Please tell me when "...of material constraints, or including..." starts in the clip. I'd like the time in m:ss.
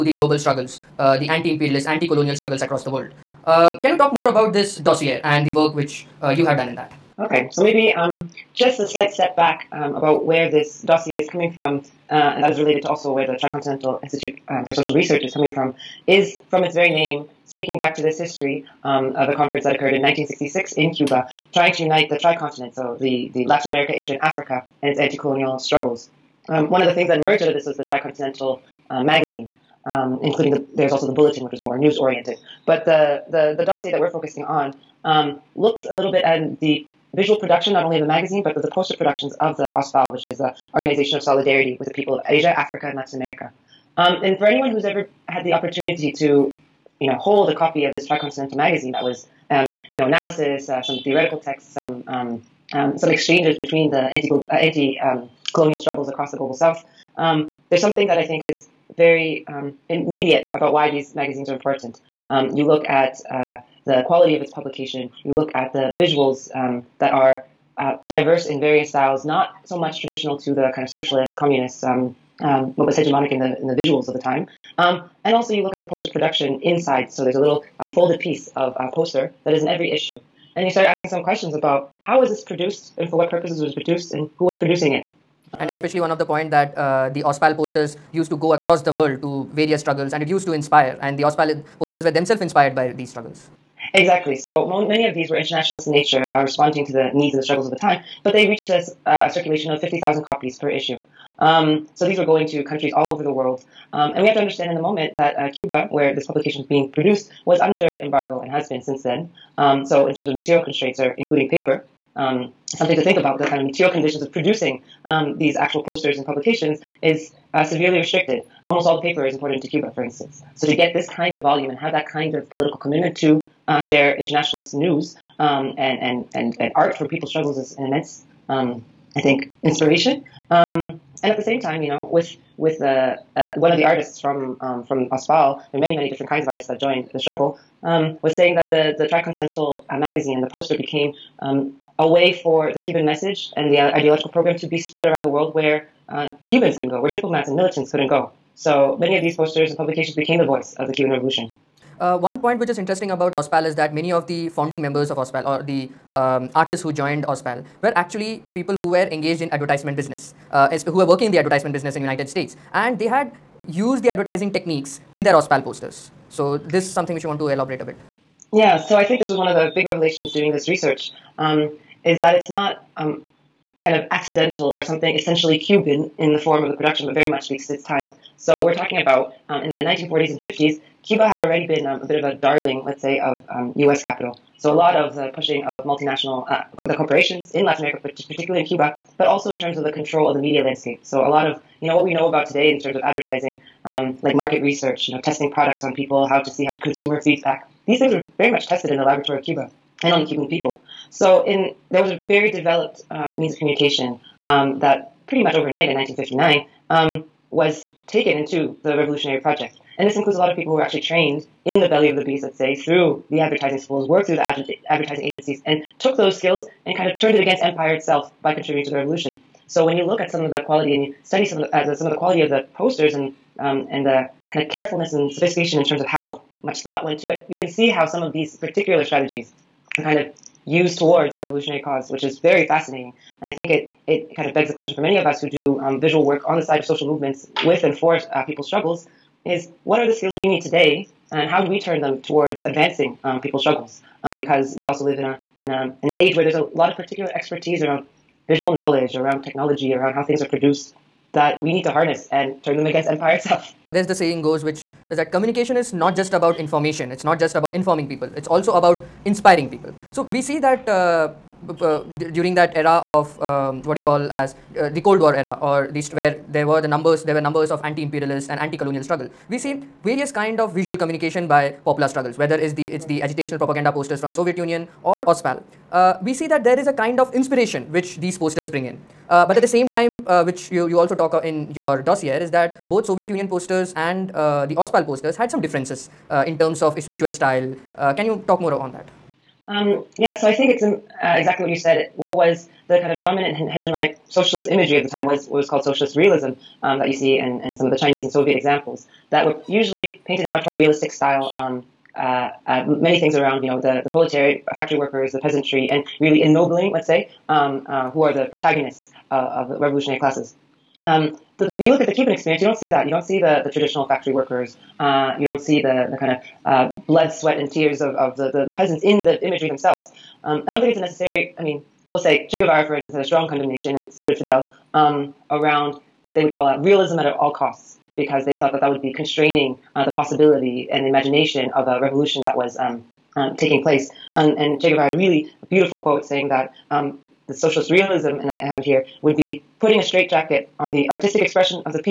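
1:50.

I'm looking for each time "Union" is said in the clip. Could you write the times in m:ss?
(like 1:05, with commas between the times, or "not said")
4:34, 4:43.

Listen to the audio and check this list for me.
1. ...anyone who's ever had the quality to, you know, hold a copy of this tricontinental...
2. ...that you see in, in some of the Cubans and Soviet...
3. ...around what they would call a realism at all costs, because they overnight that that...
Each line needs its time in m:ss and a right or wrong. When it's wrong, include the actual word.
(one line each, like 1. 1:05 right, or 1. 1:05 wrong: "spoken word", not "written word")
1. 0:44 wrong: "opportunity", not "quality"
2. 4:56 wrong: "Chinese", not "Cubans"
3. 5:25 wrong: "thought", not "overnight".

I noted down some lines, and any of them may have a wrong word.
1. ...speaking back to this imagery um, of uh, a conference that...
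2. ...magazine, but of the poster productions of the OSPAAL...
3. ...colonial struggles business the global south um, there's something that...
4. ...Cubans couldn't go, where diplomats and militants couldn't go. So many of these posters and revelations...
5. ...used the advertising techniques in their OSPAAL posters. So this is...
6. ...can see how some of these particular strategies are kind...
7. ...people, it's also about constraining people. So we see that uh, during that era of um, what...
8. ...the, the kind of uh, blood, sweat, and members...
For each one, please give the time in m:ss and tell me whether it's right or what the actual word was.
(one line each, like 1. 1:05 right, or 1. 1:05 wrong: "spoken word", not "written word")
1. 0:17 wrong: "history", not "imagery"
2. 0:38 right
3. 0:55 wrong: "across", not "business"
4. 2:26 wrong: "publications", not "revelations"
5. 2:43 right
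6. 3:47 right
7. 4:18 wrong: "inspiring", not "constraining"
8. 5:15 wrong: "tears", not "members".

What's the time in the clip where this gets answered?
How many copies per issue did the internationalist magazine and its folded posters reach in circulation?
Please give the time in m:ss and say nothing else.
1:39.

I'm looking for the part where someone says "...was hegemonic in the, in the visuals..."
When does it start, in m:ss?
1:12.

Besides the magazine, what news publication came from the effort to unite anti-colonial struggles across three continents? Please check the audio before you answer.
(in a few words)
The Bulletin.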